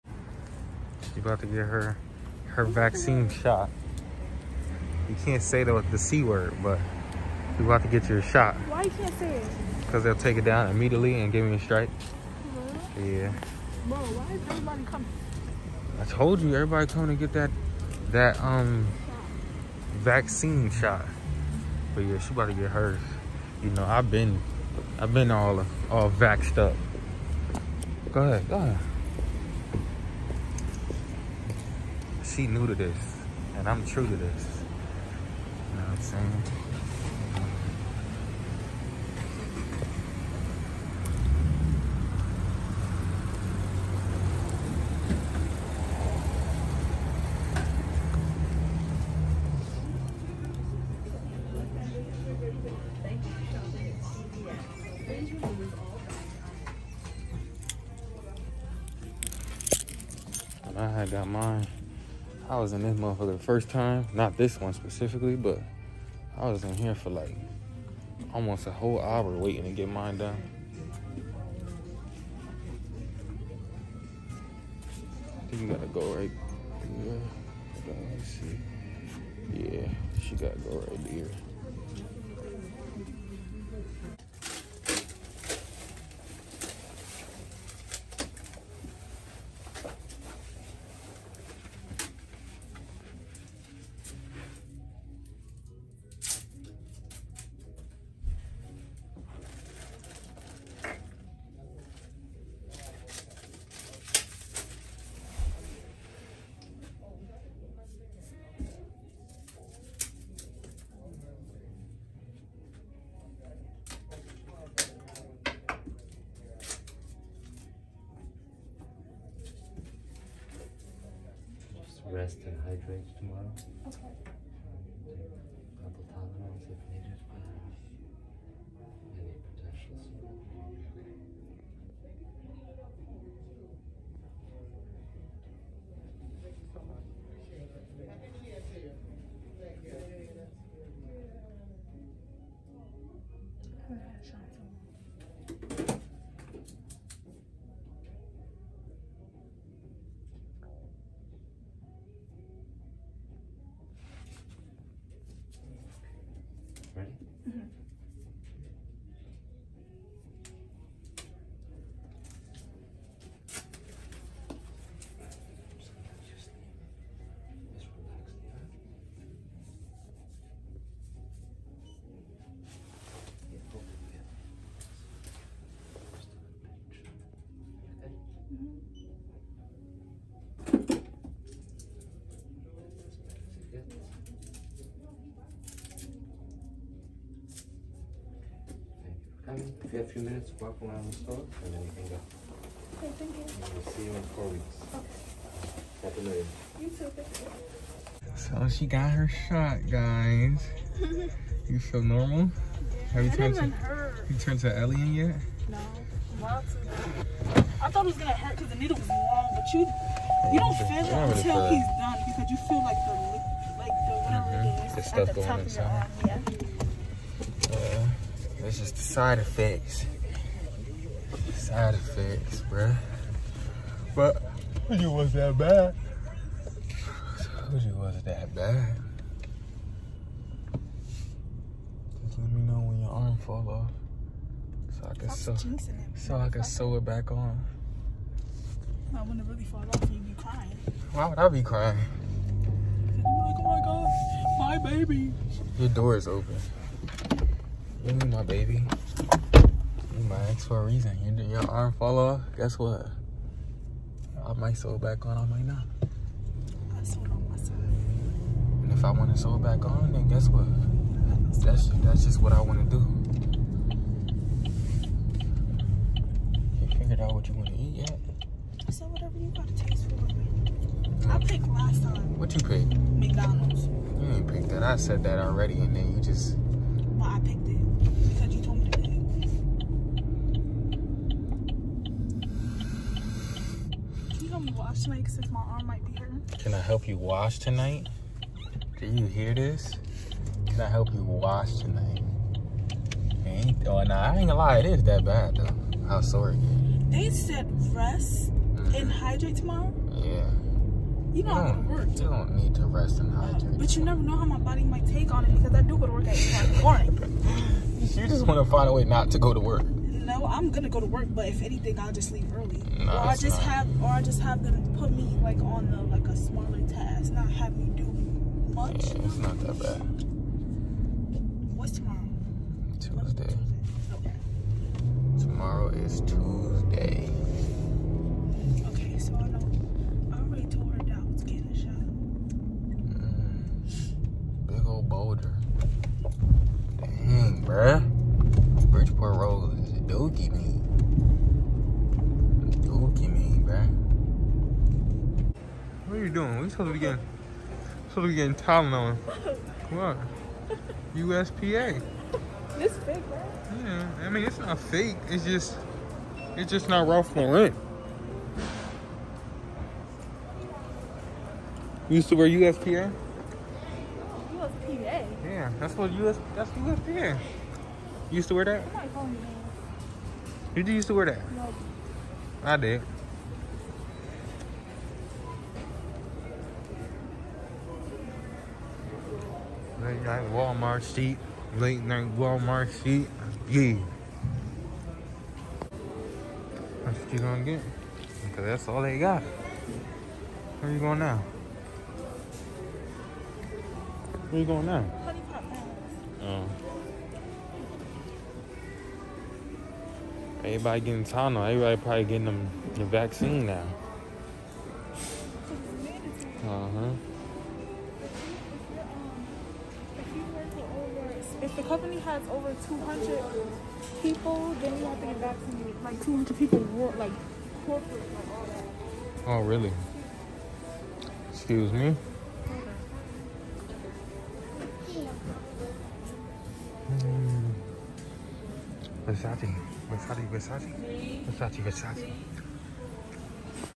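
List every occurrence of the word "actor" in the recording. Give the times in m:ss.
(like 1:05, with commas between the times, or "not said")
not said.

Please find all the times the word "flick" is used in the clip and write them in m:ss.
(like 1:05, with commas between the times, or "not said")
not said.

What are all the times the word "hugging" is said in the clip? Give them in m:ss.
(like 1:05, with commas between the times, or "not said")
not said.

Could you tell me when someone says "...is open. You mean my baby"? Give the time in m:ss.
4:06.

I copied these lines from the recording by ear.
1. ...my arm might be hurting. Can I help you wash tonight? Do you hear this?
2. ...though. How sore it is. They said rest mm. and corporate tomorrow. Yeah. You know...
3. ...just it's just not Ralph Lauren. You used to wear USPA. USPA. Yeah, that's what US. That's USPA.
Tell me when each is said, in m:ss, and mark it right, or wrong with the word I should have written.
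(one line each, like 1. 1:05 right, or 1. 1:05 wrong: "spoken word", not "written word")
1. 4:45 right
2. 4:55 wrong: "hydrate", not "corporate"
3. 5:55 right.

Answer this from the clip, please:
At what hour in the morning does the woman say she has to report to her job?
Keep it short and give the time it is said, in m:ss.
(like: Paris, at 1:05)
8, at 5:06.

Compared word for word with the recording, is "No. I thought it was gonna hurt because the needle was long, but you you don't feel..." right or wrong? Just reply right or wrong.
right.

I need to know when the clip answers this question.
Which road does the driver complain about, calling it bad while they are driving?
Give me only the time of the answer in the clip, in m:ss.
5:38.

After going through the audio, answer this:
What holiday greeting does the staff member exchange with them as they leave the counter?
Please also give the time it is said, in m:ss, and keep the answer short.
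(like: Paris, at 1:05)
Happy New Year, at 3:16.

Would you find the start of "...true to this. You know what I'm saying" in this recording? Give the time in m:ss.
0:33.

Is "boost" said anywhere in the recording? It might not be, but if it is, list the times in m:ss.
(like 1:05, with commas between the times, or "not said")
not said.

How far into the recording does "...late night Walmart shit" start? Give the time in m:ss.
6:21.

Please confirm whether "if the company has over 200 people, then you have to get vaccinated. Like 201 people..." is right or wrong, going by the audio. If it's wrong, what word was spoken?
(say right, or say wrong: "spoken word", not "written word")
wrong: "200", not "201".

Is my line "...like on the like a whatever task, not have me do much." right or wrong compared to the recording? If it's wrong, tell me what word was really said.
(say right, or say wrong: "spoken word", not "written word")
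wrong: "smaller", not "whatever".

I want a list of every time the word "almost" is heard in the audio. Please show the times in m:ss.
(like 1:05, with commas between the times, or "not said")
1:08.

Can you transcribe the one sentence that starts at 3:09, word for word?
If you have a few minutes, walk around the store and then you can go.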